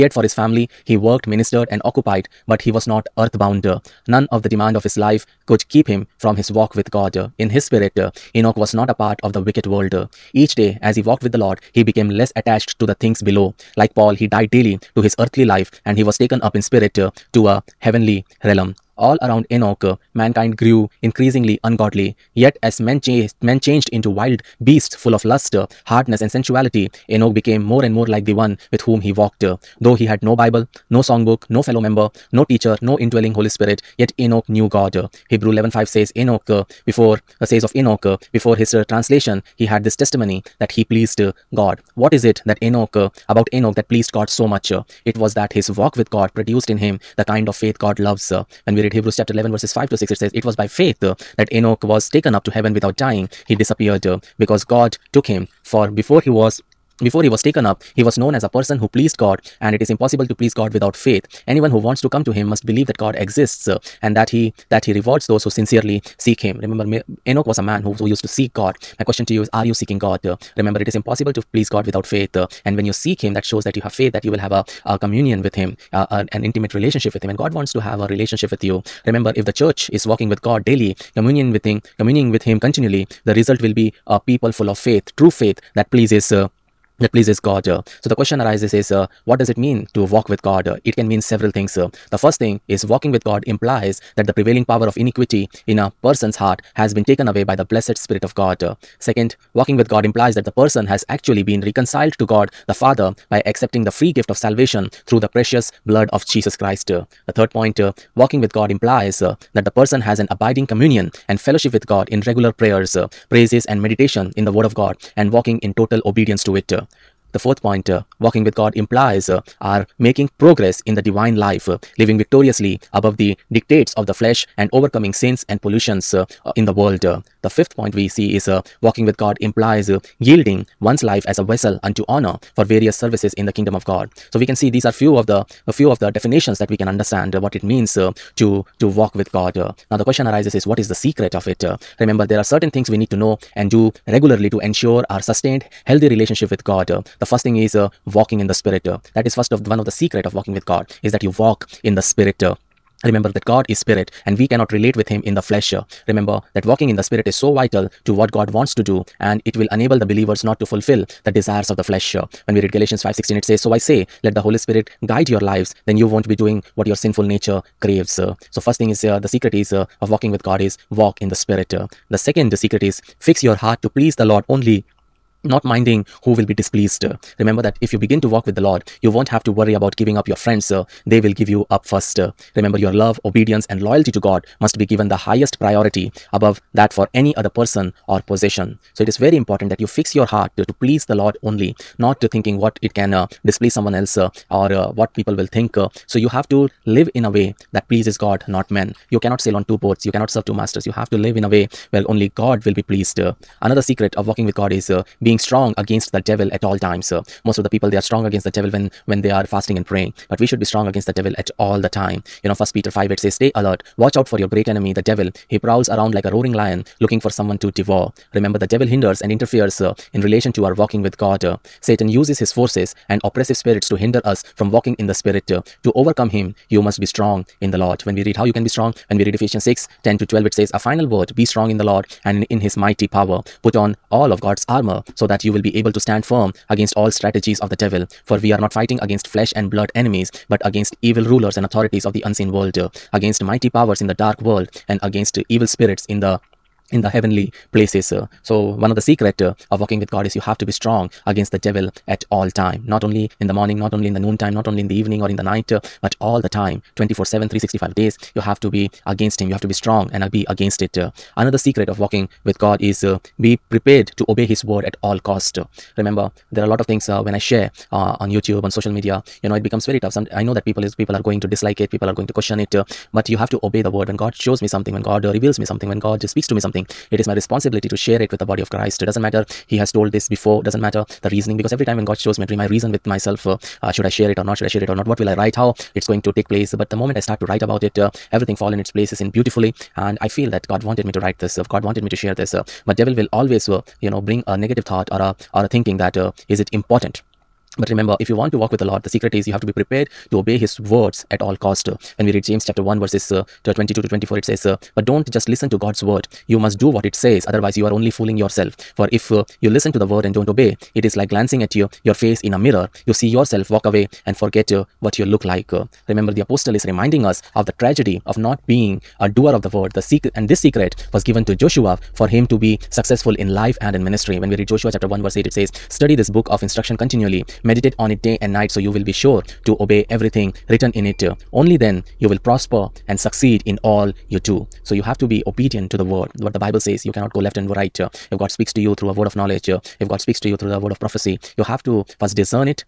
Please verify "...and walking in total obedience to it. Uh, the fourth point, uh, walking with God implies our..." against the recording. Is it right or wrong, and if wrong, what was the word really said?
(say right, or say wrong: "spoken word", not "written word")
right.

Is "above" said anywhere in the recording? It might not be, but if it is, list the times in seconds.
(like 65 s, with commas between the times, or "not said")
122 s, 186 s.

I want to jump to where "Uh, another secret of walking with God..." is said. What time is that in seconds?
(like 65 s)
260 s.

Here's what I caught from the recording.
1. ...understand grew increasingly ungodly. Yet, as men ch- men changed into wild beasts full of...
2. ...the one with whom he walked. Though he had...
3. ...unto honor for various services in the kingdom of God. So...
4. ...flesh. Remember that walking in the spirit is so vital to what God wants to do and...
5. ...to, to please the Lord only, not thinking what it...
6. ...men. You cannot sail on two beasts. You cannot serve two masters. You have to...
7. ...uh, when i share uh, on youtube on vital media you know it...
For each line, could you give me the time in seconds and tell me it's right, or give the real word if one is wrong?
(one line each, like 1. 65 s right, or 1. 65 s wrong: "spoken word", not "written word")
1. 20 s wrong: "mankind", not "understand"
2. 28 s right
3. 131 s right
4. 155 s right
5. 190 s right
6. 198 s wrong: "boats", not "beasts"
7. 267 s wrong: "social", not "vital".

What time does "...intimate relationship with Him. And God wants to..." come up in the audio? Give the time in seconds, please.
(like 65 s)
76 s.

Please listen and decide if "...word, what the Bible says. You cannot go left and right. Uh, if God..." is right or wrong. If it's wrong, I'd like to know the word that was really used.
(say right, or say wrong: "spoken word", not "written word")
right.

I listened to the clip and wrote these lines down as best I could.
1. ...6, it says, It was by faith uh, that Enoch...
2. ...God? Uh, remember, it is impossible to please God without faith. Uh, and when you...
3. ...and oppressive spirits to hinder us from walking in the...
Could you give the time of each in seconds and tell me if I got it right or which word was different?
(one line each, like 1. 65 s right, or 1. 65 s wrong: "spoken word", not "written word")
1. 49 s right
2. 69 s right
3. 223 s right.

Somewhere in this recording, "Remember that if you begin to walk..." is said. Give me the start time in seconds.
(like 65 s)
177 s.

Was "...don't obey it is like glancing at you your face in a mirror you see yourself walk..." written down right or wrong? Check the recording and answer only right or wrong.
right.